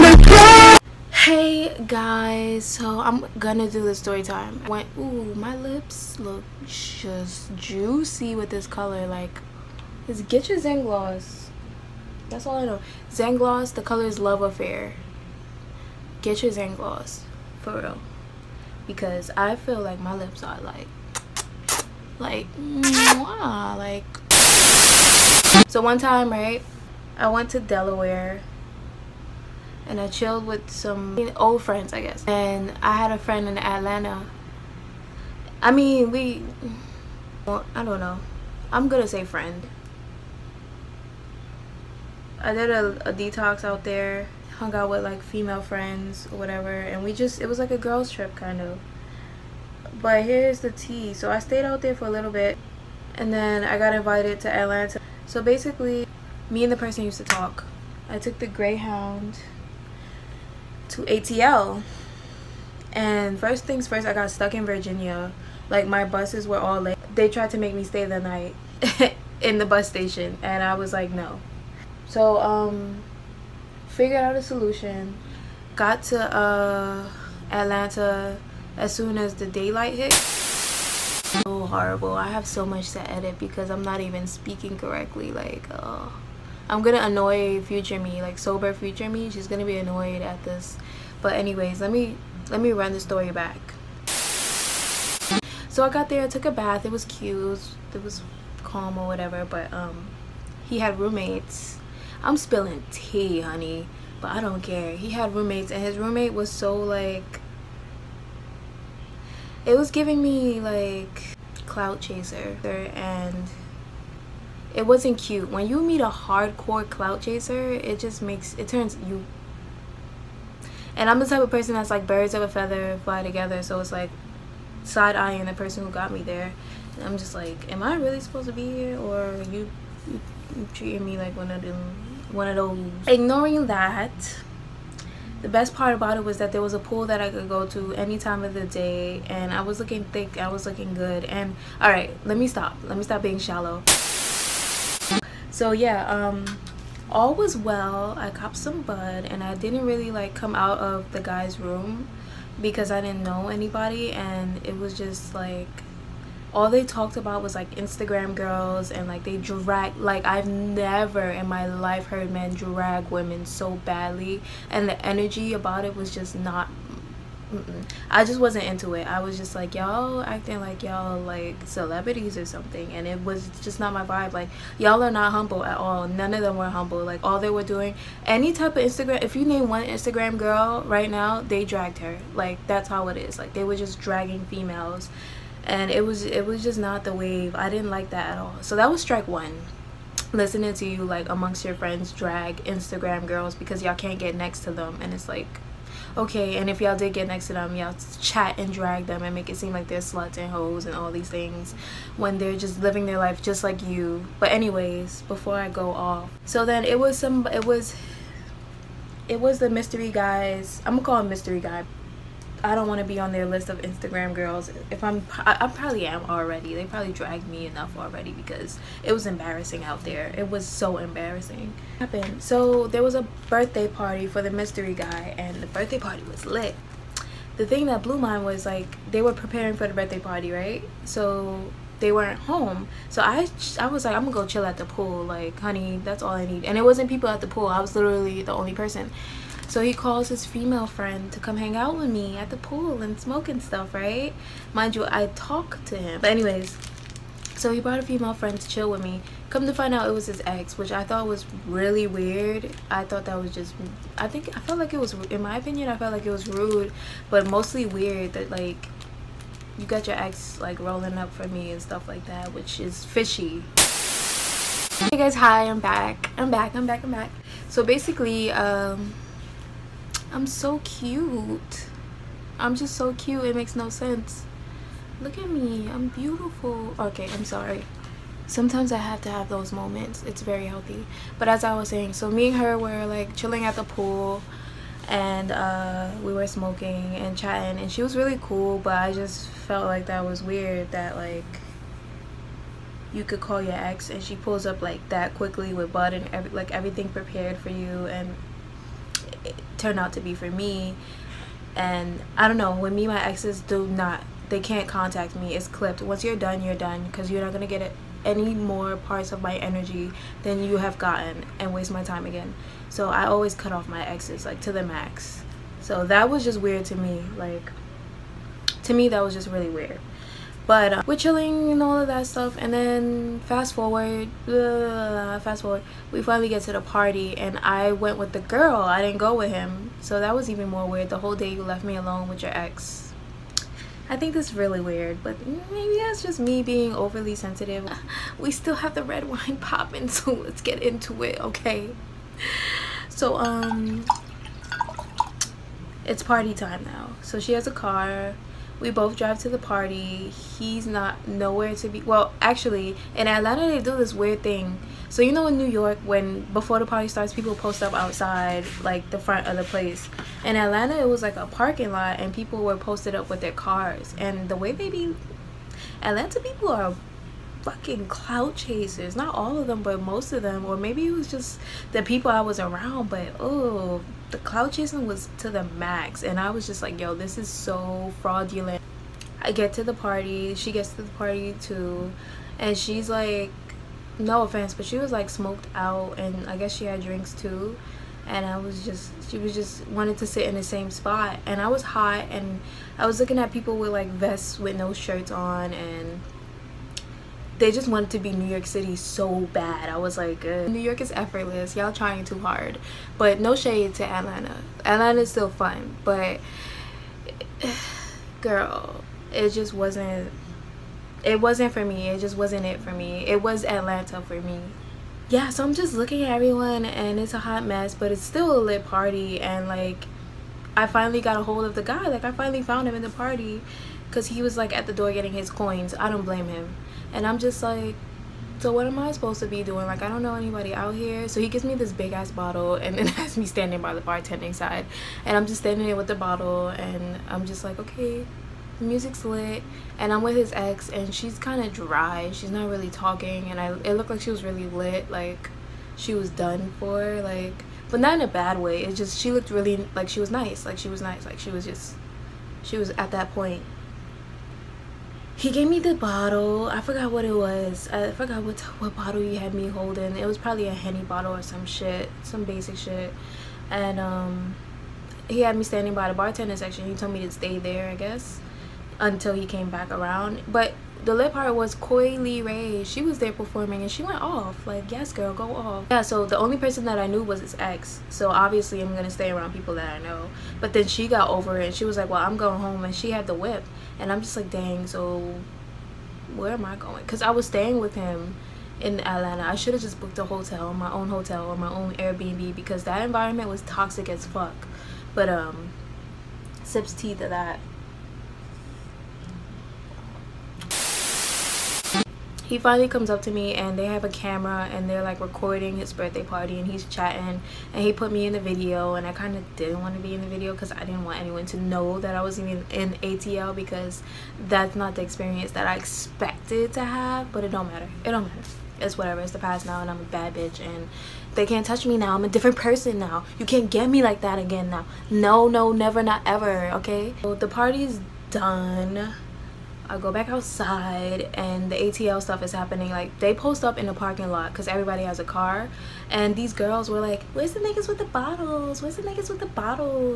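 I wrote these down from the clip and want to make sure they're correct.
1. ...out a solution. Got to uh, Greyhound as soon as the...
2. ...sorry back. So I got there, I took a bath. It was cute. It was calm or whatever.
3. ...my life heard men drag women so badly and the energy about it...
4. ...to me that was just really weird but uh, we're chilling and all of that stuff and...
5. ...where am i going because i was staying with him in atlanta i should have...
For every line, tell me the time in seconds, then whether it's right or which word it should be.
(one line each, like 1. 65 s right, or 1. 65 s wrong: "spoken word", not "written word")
1. 74 s wrong: "Atlanta", not "Greyhound"
2. 92 s wrong: "story", not "sorry"
3. 161 s right
4. 318 s right
5. 486 s right.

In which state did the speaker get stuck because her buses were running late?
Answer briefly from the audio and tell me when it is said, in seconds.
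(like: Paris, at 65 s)
Virginia, at 64 s.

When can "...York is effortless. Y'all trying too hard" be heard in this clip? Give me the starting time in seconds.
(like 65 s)
400 s.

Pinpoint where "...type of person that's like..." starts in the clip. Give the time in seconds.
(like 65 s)
121 s.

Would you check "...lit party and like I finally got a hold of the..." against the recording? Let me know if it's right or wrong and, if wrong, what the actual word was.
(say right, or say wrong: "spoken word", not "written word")
right.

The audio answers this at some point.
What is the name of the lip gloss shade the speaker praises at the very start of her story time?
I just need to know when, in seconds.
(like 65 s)
14 s.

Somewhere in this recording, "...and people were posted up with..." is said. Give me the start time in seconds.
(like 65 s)
362 s.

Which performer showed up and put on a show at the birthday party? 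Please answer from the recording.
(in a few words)
Coi Leray.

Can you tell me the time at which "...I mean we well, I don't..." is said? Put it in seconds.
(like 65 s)
35 s.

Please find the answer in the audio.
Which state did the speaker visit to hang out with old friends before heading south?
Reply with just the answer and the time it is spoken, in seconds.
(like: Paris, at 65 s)
Delaware, at 27 s.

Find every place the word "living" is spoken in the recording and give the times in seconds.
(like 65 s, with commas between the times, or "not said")
202 s.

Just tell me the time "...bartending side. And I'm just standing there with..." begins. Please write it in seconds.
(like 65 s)
434 s.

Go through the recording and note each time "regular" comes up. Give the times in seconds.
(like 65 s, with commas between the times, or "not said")
not said.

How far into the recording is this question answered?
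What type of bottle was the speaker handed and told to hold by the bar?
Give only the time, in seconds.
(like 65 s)
460 s.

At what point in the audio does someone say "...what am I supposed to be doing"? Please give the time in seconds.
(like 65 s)
428 s.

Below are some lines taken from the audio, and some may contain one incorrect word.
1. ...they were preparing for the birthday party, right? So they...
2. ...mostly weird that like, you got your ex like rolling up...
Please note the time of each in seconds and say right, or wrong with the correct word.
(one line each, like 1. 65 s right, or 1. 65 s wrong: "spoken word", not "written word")
1. 229 s right
2. 257 s right.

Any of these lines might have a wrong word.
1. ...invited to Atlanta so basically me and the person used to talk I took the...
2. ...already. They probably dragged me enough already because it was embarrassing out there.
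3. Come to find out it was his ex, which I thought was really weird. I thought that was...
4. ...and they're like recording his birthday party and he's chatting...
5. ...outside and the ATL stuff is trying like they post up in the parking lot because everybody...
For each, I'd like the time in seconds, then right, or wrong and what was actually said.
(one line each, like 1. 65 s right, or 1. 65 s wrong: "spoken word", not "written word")
1. 53 s right
2. 216 s right
3. 249 s right
4. 504 s right
5. 530 s wrong: "happening", not "trying".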